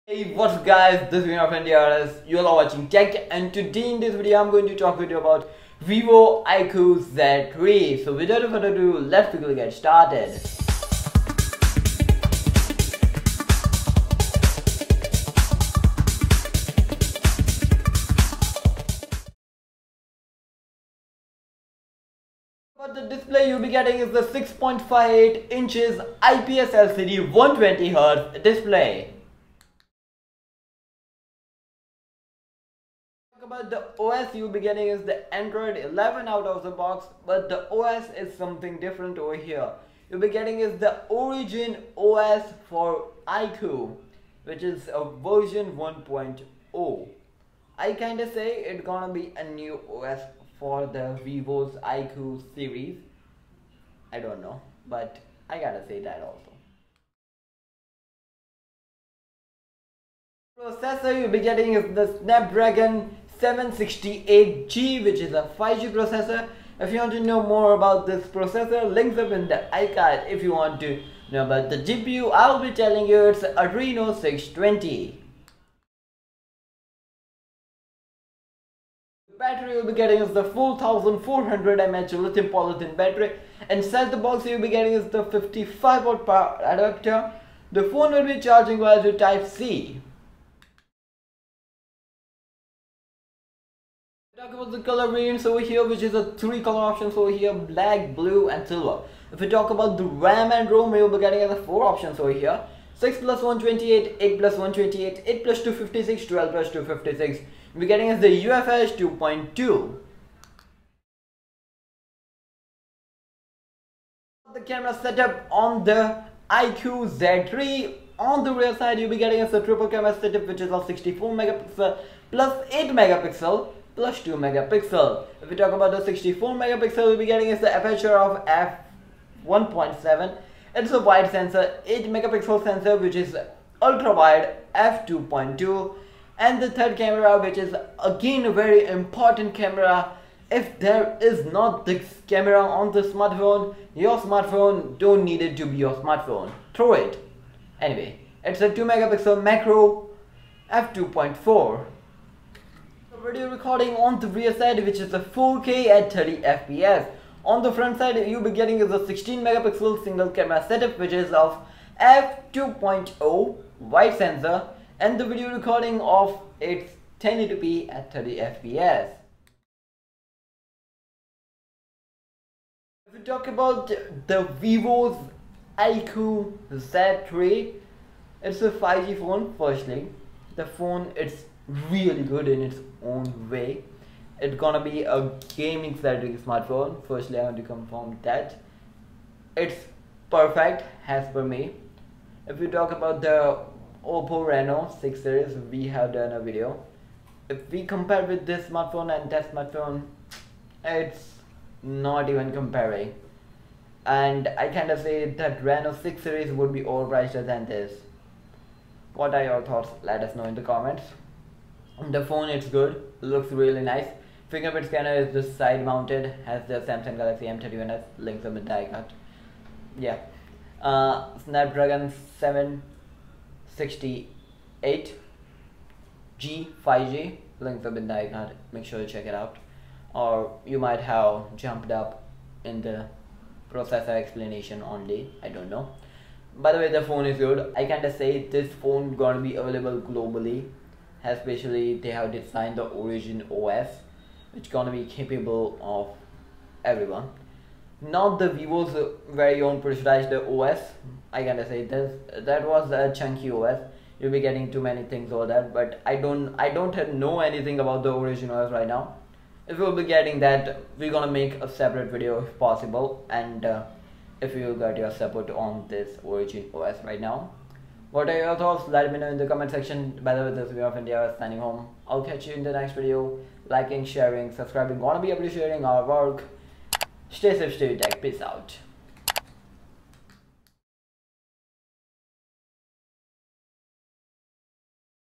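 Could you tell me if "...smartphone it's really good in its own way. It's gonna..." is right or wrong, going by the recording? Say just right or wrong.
wrong.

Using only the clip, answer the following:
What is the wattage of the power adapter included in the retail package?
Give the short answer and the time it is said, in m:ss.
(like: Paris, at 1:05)
55 watt, at 1:25.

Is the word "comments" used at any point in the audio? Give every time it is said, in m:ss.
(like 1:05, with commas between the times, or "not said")
3:30, 4:29.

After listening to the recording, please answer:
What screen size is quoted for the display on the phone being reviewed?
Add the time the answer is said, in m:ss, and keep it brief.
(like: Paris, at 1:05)
6.58 inches, at 0:24.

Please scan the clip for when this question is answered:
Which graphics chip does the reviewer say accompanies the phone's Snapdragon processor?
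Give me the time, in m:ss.
1:13.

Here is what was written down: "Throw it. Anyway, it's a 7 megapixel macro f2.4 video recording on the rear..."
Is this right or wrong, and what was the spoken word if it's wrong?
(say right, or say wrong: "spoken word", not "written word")
wrong: "2", not "7".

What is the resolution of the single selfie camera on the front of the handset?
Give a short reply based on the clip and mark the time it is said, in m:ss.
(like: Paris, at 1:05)
16 megapixel, at 2:39.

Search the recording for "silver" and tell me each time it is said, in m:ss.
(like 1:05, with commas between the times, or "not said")
1:38.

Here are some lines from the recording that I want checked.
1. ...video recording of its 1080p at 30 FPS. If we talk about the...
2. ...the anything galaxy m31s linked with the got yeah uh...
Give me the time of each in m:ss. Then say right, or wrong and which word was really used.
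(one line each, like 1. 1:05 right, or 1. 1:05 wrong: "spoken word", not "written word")
1. 2:45 right
2. 3:36 wrong: "samsung", not "anything".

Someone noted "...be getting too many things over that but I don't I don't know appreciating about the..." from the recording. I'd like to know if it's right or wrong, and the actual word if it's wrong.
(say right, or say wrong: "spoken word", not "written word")
wrong: "anything", not "appreciating".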